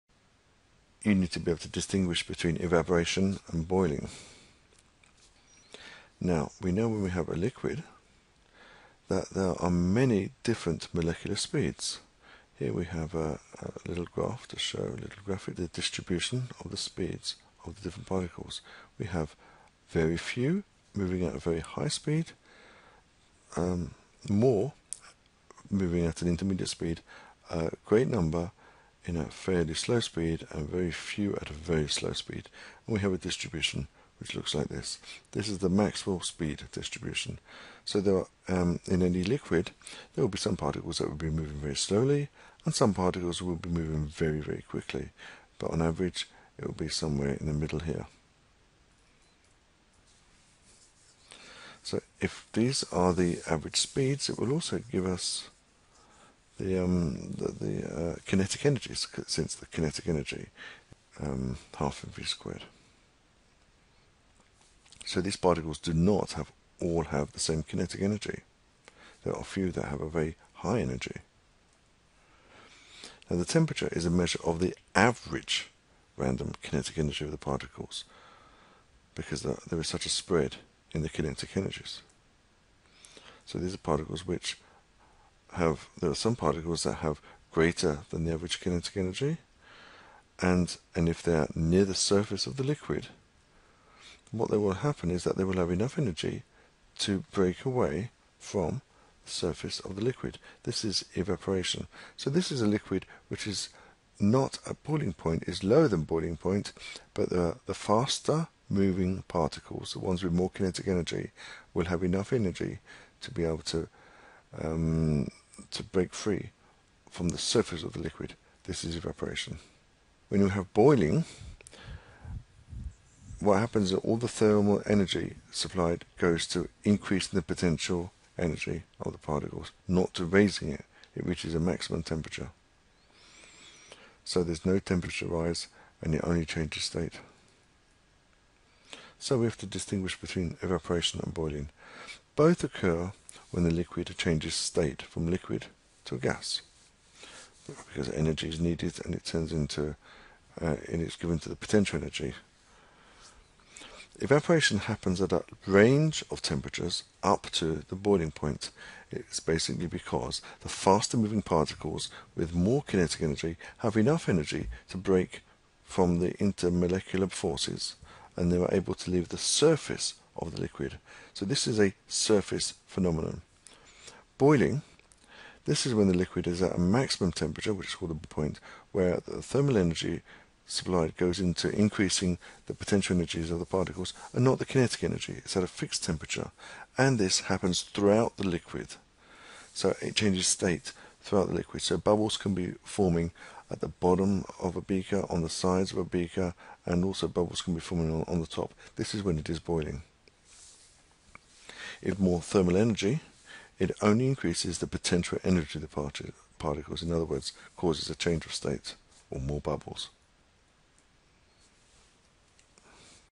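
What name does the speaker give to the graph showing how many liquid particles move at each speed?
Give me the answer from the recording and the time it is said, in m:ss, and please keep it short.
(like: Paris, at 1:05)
Maxwell speed distribution, at 0:35.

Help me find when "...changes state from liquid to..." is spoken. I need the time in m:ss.
2:24.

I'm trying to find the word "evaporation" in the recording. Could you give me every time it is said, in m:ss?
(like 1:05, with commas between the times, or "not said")
0:02, 1:41, 1:58, 2:20, 2:34.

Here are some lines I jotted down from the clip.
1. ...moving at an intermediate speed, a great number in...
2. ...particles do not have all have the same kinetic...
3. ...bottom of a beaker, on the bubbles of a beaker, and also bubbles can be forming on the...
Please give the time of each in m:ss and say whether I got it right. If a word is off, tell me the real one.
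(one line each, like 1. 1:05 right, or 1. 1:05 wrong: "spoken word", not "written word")
1. 0:25 right
2. 1:05 right
3. 3:13 wrong: "sides", not "bubbles".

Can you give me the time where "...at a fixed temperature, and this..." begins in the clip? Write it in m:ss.
3:05.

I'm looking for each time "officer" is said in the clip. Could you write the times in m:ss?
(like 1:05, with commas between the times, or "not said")
not said.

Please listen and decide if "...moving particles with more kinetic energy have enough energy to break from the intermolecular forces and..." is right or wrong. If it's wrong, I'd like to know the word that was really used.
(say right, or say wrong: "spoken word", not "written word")
right.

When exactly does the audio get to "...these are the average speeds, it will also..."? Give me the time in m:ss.
0:52.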